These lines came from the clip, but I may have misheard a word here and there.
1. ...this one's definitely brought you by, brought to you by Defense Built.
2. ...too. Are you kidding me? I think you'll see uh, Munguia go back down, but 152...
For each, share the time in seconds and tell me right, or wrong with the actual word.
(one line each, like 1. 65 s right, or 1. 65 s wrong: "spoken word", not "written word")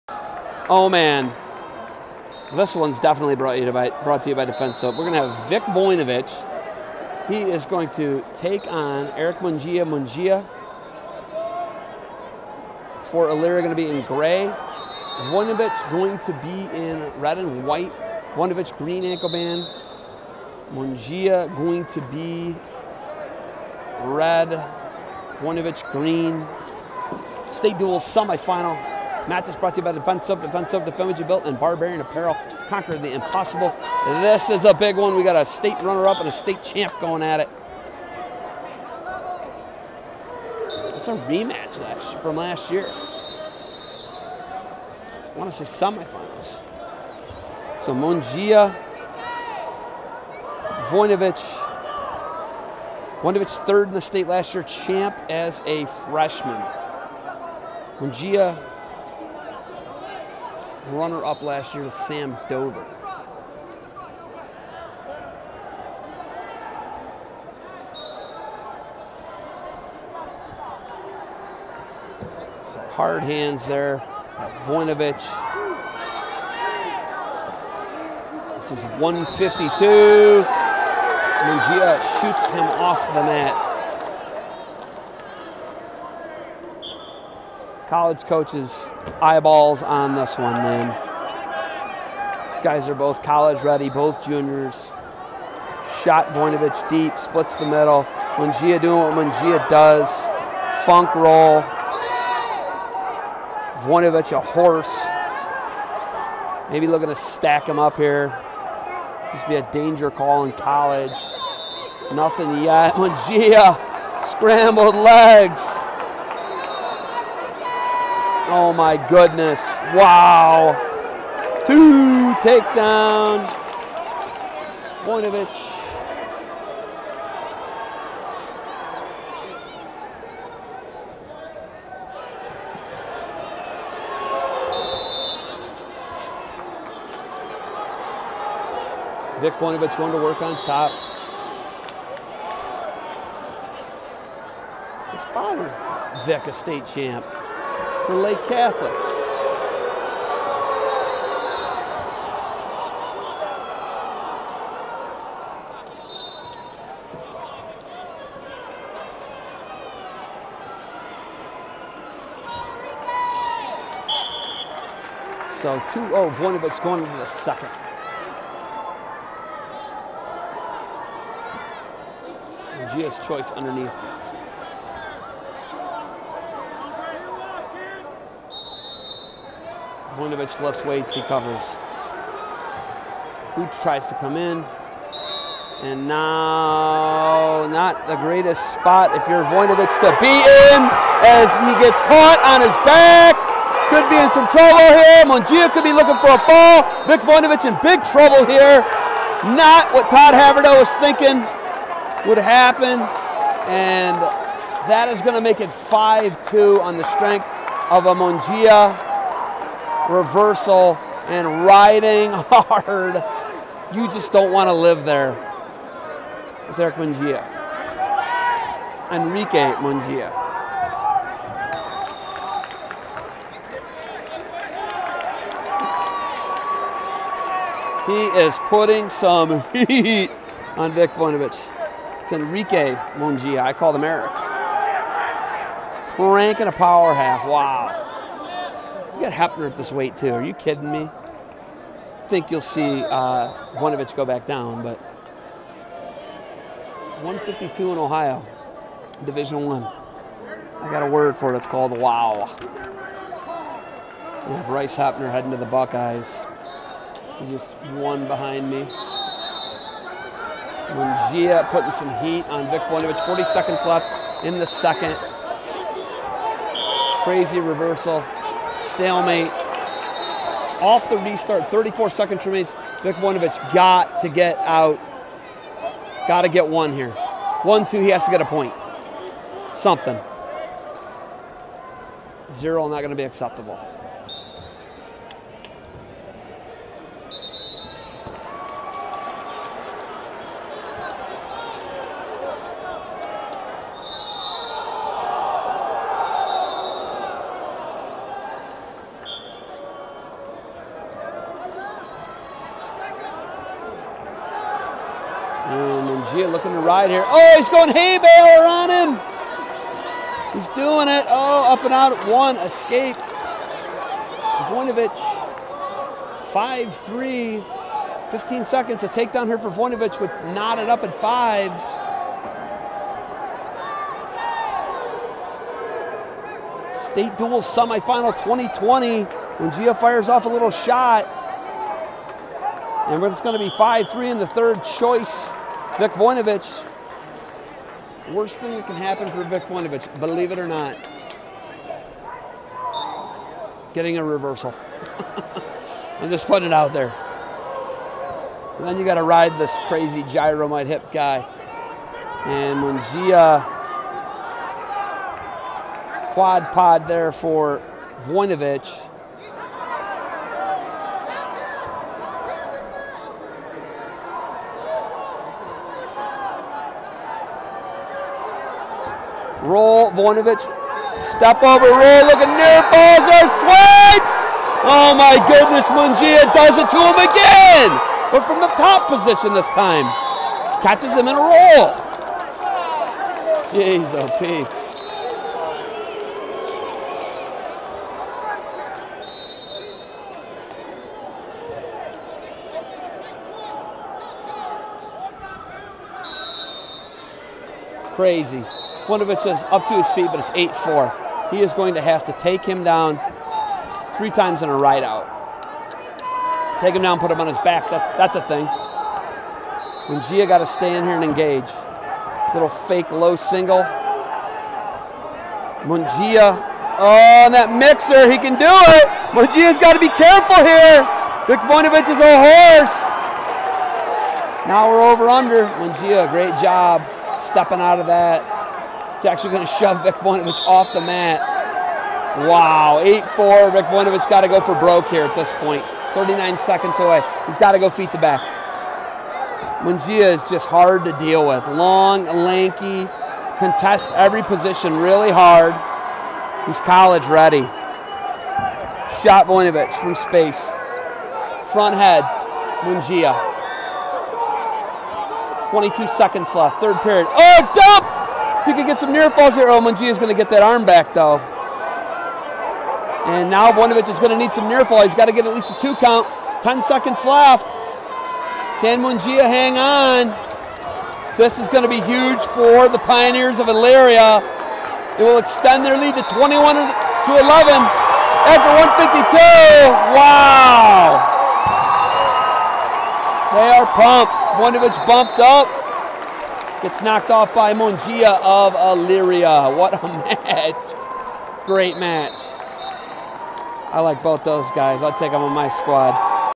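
1. 2 s wrong: "Soap", not "Built"
2. 240 s wrong: "Voinovich", not "Munguia".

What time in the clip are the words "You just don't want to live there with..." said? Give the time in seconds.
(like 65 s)
213 s.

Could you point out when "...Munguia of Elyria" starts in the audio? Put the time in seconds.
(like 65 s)
487 s.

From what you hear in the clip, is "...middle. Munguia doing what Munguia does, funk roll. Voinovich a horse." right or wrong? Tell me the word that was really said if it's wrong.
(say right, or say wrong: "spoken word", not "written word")
right.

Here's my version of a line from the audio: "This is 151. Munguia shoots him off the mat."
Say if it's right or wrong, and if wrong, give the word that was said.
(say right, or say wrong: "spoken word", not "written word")
wrong: "152", not "151".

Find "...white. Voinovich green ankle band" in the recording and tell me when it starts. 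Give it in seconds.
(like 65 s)
17 s.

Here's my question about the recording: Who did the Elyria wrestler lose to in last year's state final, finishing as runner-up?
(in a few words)
Sam Dover.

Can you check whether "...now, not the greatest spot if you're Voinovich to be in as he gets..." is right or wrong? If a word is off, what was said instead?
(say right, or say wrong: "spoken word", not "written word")
right.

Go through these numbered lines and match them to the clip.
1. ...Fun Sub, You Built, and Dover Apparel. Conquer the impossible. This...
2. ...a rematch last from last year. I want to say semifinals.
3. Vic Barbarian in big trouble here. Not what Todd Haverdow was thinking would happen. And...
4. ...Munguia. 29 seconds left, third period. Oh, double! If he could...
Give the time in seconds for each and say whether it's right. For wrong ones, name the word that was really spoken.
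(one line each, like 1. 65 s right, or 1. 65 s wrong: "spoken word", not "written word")
1. 31 s wrong: "Barbarian", not "Dover"
2. 41 s right
3. 197 s wrong: "Voinovich", not "Barbarian"
4. 452 s wrong: "22", not "29".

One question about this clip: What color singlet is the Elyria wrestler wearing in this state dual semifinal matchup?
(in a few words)
Gray.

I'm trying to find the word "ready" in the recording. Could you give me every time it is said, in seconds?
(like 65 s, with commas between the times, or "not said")
93 s, 447 s.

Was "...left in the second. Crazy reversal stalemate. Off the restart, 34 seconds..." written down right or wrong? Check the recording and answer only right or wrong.
right.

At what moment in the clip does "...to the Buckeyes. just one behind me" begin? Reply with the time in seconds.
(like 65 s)
255 s.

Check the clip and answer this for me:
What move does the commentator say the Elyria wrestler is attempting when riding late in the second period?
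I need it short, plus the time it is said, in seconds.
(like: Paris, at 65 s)
Hay baler, at 307 s.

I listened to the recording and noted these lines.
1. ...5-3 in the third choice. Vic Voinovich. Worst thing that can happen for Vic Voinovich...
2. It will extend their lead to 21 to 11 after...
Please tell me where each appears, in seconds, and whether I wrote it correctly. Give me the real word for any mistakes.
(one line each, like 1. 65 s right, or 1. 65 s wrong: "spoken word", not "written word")
1. 333 s right
2. 475 s right.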